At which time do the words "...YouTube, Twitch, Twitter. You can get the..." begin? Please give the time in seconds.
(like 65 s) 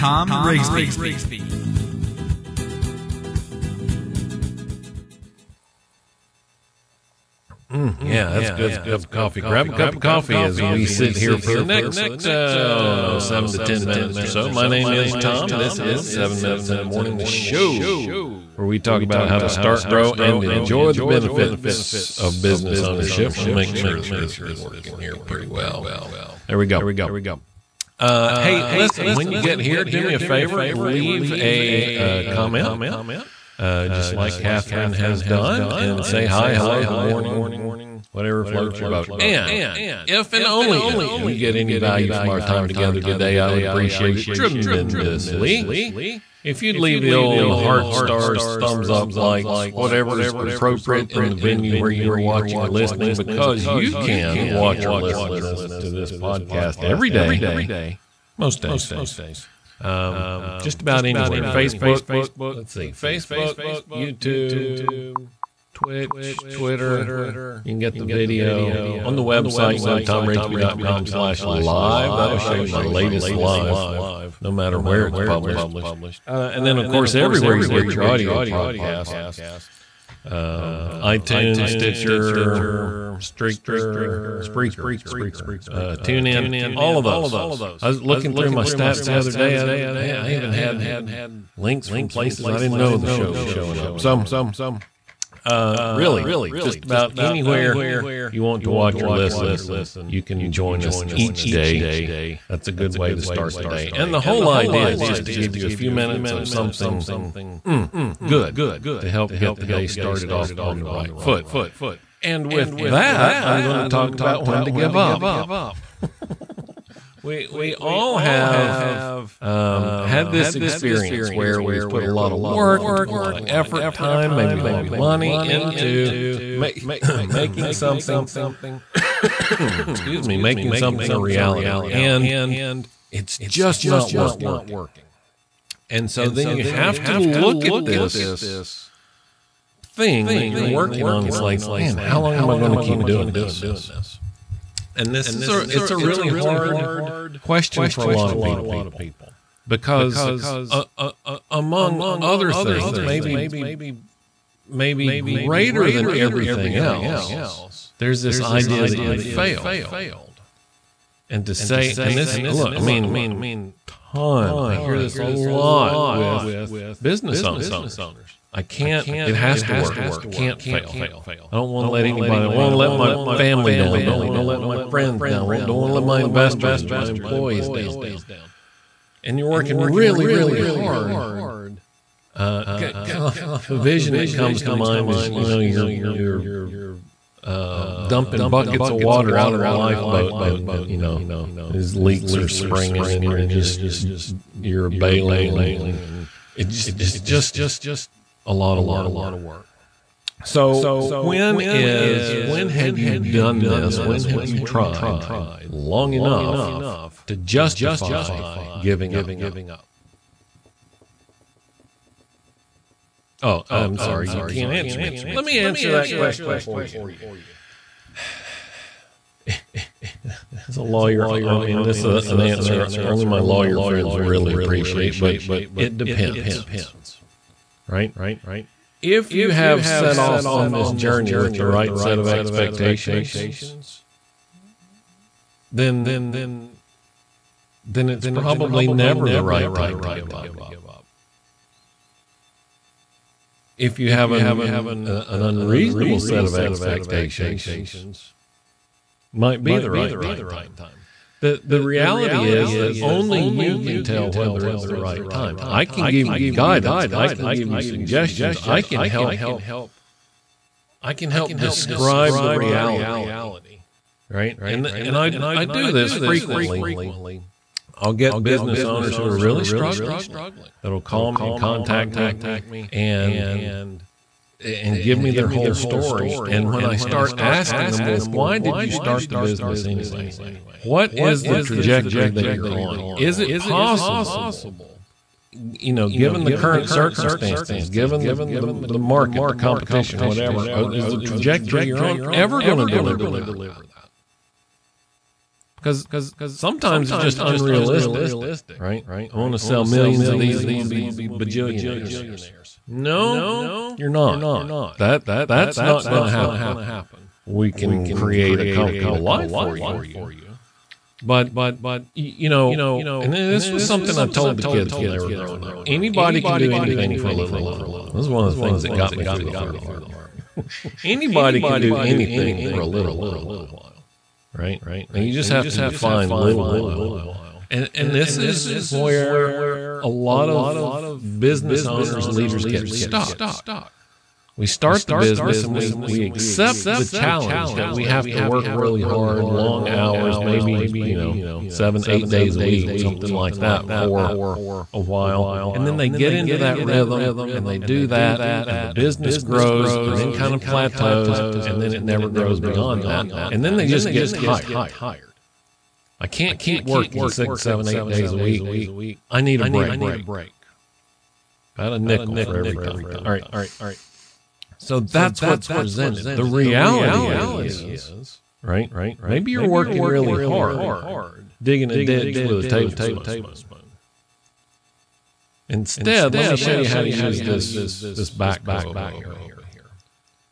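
63 s.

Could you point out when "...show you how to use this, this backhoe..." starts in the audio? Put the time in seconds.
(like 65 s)
376 s.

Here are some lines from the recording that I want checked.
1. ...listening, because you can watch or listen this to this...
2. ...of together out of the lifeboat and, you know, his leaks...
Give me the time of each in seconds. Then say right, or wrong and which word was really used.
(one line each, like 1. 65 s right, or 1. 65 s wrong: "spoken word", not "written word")
1. 52 s right
2. 188 s wrong: "water", not "together".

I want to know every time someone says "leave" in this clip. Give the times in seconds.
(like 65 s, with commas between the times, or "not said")
30 s, 46 s.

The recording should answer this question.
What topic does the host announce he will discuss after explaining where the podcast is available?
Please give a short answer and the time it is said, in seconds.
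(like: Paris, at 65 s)
When to give up, at 114 s.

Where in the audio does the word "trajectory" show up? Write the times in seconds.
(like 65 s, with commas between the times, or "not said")
281 s, 291 s.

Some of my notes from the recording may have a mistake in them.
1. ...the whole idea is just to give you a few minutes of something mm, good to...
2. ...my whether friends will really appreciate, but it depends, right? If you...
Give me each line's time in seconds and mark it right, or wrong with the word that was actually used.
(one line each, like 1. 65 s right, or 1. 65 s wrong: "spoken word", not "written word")
1. 104 s right
2. 223 s wrong: "lawyer", not "whether".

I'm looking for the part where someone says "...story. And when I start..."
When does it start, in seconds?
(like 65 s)
275 s.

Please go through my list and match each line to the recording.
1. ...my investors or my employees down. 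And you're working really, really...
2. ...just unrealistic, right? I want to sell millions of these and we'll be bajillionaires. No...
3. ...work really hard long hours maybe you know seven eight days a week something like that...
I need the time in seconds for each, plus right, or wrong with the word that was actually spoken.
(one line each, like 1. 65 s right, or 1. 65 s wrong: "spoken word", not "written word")
1. 176 s right
2. 297 s right
3. 338 s right.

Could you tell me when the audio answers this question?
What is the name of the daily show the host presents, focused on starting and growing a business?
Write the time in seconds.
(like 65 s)
16 s.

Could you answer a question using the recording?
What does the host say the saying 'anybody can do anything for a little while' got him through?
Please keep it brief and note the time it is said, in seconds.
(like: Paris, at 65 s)
The army, at 319 s.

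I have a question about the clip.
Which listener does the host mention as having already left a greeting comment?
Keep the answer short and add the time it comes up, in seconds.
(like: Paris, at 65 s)
Catherine, at 34 s.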